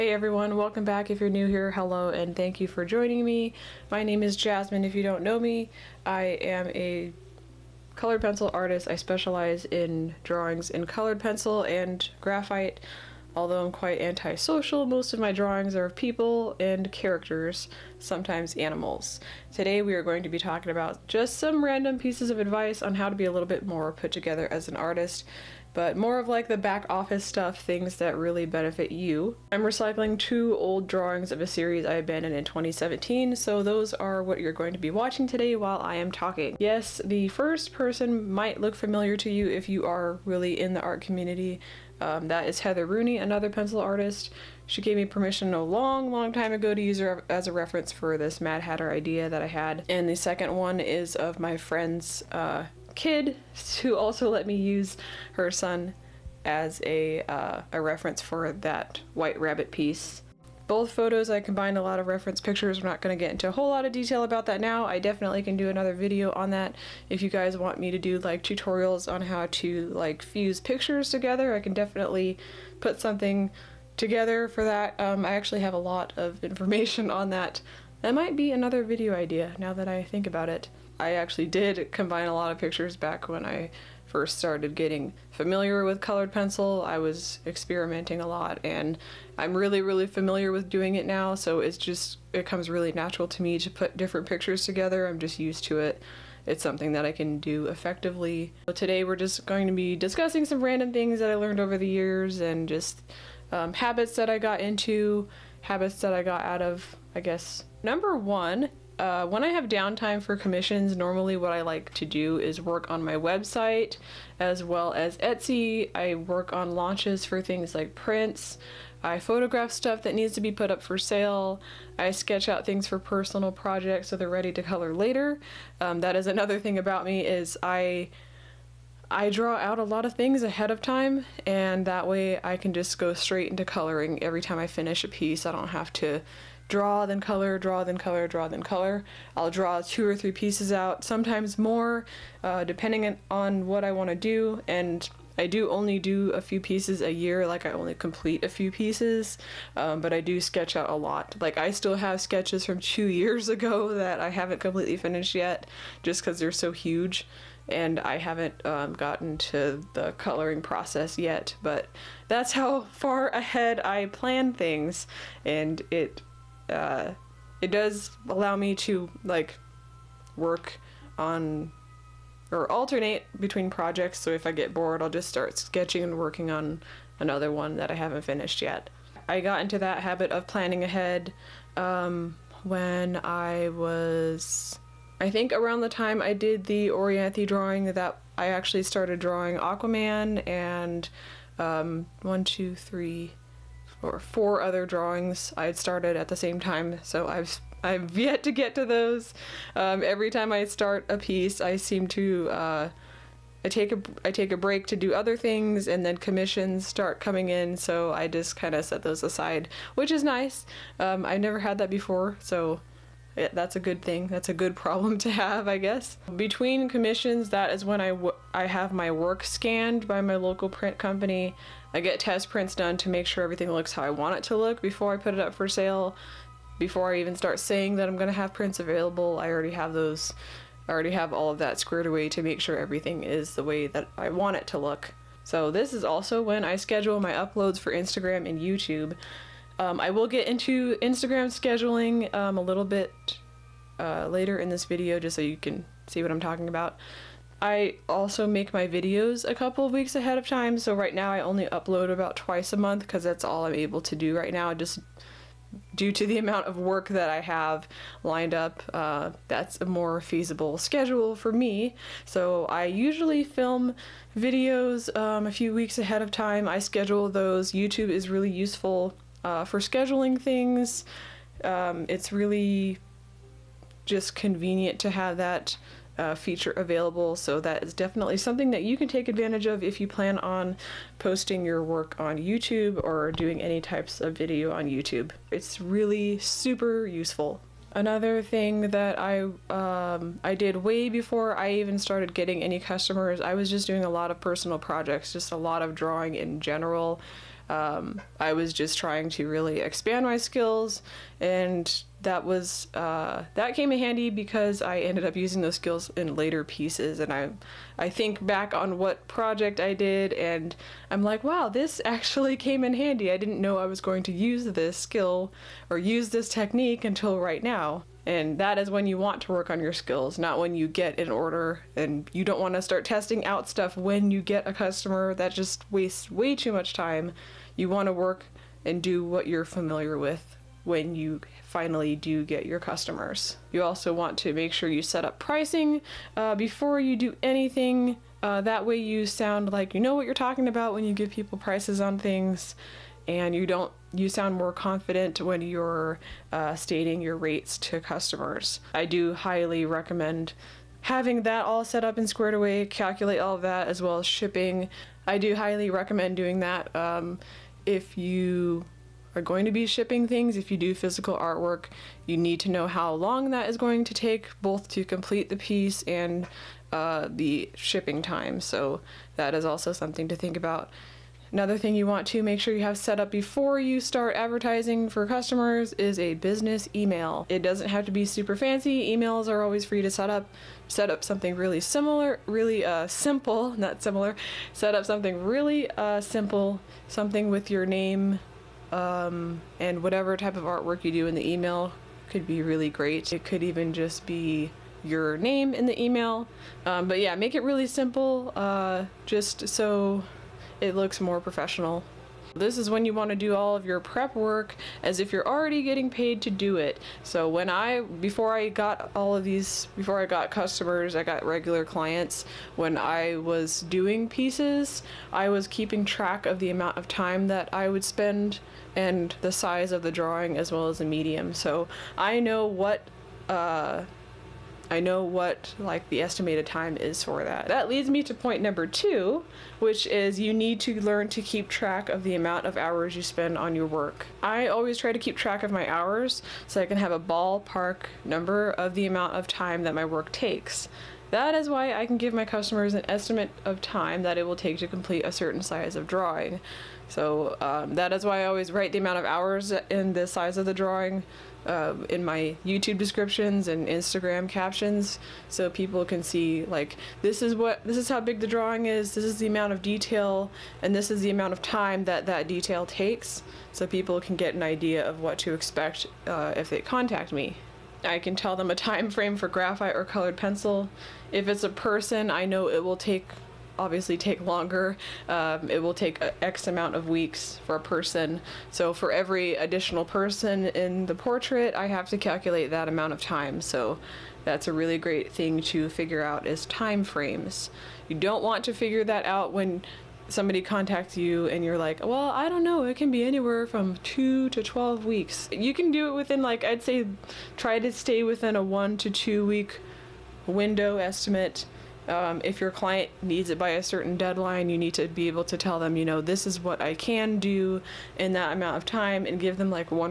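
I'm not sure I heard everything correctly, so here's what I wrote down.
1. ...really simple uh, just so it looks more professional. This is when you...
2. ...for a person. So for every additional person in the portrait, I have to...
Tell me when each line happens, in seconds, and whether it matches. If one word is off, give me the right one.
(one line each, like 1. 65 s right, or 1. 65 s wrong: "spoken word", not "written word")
1. 397 s right
2. 477 s right.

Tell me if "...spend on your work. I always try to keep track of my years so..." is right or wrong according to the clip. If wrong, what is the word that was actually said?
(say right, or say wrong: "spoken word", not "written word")
wrong: "hours", not "years".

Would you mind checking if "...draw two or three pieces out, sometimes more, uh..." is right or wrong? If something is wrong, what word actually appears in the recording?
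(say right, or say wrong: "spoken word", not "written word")
right.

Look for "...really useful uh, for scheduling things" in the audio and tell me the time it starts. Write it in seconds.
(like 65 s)
268 s.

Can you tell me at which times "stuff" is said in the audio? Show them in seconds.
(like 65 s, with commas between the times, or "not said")
27 s, 119 s, 323 s.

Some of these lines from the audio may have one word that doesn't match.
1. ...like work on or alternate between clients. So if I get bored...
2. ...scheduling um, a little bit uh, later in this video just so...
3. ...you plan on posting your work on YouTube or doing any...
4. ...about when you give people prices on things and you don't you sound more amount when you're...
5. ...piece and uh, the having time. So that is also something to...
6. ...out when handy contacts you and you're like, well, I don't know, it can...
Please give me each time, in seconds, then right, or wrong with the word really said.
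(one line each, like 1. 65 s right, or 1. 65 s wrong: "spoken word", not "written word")
1. 169 s wrong: "projects", not "clients"
2. 241 s right
3. 280 s right
4. 340 s wrong: "confident", not "amount"
5. 365 s wrong: "shipping", not "having"
6. 489 s wrong: "somebody", not "handy".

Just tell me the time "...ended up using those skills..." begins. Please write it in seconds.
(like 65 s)
304 s.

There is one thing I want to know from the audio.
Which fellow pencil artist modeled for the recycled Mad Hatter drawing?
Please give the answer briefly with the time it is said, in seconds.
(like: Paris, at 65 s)
Heather Rooney, at 42 s.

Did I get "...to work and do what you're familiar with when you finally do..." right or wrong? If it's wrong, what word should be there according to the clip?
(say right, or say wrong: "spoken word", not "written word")
right.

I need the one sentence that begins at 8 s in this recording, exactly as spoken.
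I specialize in drawings in colored pencil and graphite.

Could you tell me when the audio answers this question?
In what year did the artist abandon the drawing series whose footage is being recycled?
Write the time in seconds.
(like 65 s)
32 s.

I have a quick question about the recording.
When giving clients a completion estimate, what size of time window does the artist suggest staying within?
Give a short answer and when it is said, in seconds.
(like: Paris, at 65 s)
1 to 2 weeks, at 498 s.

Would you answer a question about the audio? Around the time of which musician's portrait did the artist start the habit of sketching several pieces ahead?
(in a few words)
Orianthi.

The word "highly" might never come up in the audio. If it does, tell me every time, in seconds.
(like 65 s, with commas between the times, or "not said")
349 s, 355 s.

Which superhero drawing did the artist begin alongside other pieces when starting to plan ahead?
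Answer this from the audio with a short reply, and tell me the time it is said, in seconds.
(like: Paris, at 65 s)
Aquaman, at 189 s.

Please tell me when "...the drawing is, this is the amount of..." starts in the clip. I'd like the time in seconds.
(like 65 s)
458 s.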